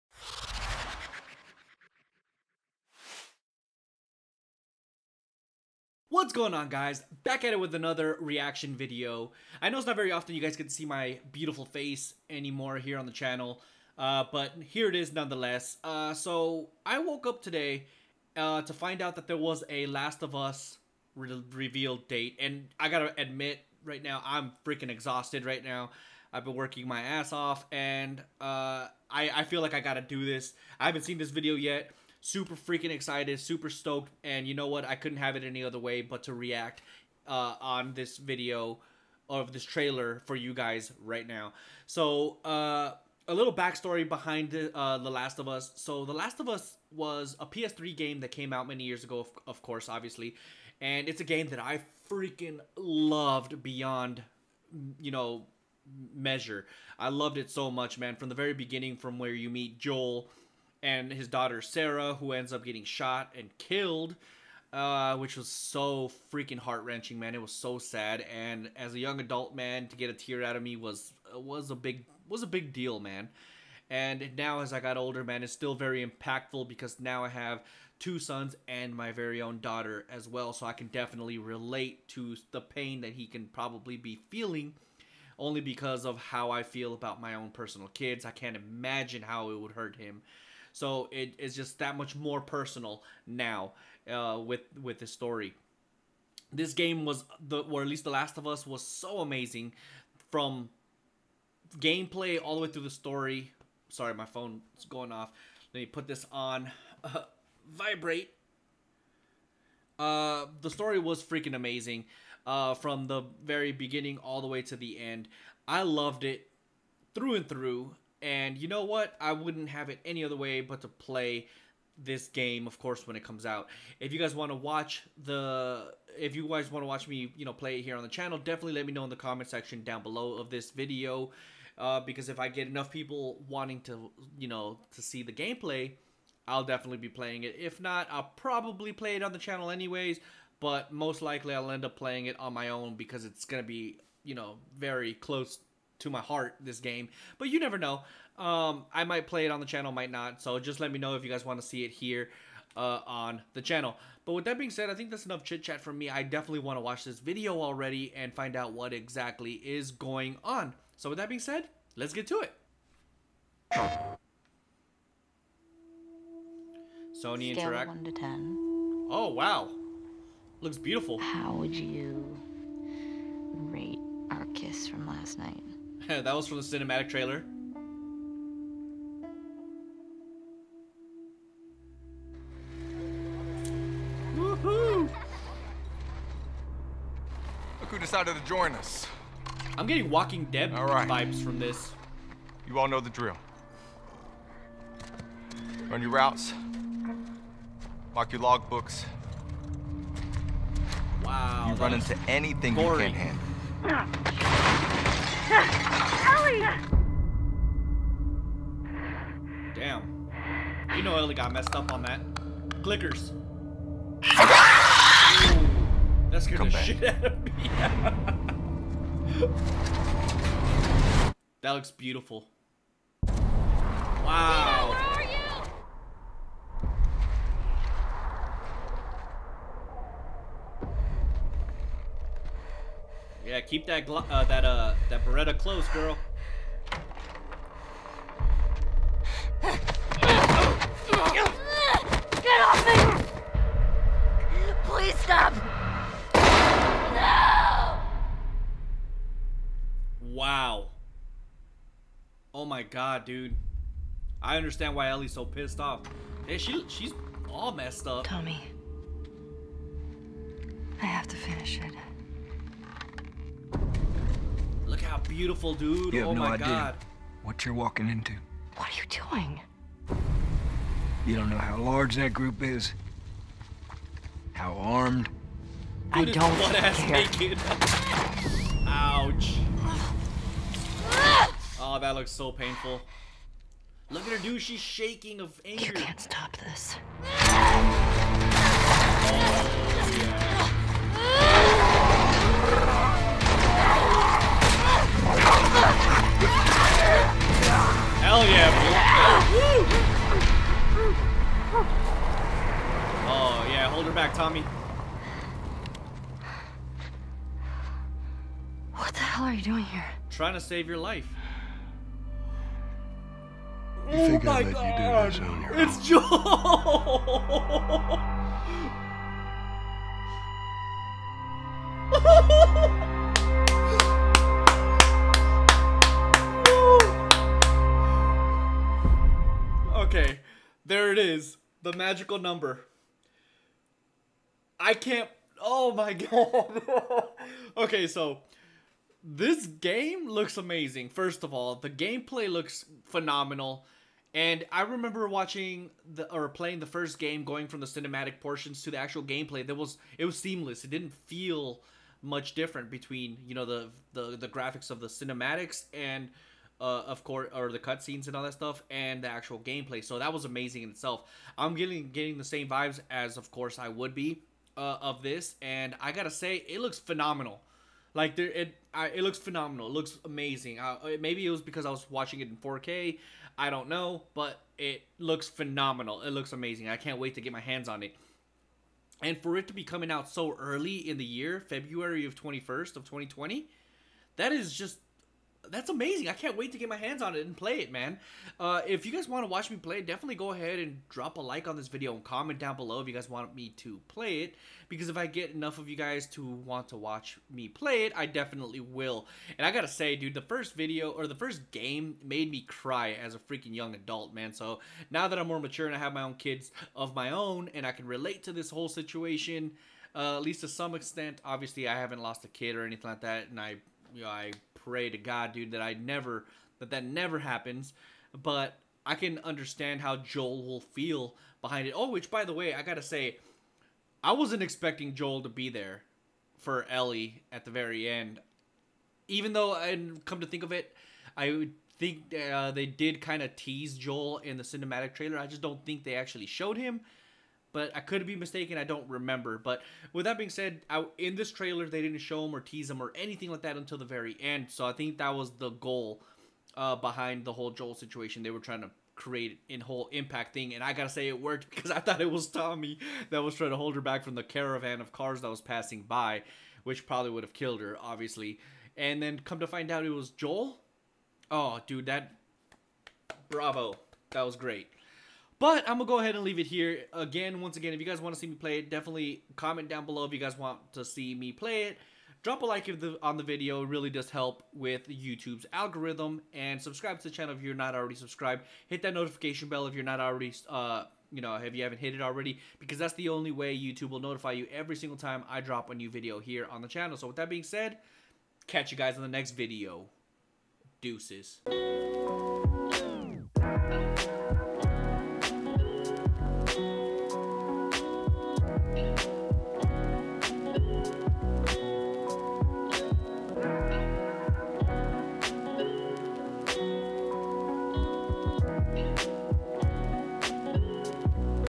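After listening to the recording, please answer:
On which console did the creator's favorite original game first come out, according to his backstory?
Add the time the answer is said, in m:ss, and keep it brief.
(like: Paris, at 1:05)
PS3, at 0:47.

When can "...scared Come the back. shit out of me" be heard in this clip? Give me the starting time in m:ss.
3:36.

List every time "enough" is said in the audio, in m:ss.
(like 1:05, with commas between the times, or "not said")
2:12, 2:35, 6:35.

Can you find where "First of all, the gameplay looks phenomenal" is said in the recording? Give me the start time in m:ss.
5:41.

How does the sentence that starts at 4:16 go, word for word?
Hey, she she's all messed up.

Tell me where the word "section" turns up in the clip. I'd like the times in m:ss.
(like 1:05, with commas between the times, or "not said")
2:09.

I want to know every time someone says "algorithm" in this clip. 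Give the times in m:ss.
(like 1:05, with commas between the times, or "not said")
7:55.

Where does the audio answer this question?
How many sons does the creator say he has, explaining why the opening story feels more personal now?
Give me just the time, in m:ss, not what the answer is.
1:17.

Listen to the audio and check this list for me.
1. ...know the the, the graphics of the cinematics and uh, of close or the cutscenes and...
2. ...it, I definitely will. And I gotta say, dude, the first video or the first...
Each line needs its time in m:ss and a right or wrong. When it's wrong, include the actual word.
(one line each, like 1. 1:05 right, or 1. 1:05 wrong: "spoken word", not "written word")
1. 5:53 wrong: "course", not "close"
2. 6:38 right.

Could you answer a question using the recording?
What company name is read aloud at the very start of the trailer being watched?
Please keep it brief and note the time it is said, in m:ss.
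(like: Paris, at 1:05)
Sony, at 2:47.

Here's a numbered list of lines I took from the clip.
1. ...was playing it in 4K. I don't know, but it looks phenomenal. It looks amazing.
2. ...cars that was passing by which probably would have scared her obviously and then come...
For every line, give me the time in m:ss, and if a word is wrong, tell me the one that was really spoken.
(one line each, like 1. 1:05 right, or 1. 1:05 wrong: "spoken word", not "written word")
1. 6:11 wrong: "watching", not "playing"
2. 7:35 wrong: "killed", not "scared".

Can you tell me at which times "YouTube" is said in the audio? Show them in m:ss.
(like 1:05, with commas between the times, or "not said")
7:55, 8:03.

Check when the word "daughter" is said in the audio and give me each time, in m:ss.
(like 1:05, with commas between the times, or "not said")
1:01, 1:19.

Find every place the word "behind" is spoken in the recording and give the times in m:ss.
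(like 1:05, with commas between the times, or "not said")
0:44, 7:01, 7:26.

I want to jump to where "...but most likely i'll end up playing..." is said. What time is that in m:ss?
2:20.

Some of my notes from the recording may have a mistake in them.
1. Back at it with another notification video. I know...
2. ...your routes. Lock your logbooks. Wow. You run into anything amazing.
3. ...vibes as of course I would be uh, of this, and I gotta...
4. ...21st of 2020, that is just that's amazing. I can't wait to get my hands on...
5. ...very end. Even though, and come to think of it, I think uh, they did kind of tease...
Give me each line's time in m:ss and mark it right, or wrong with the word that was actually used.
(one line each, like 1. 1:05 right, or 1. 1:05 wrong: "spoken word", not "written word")
1. 0:07 wrong: "reaction", not "notification"
2. 3:16 wrong: "boring", not "amazing"
3. 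6:02 right
4. 6:22 right
5. 7:07 right.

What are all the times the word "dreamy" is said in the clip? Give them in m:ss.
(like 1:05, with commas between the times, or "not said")
not said.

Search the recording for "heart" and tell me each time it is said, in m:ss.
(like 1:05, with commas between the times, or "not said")
1:06, 2:26.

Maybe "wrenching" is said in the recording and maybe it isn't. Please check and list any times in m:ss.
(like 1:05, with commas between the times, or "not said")
1:06.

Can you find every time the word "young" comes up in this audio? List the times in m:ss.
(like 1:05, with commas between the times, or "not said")
1:08, 6:43.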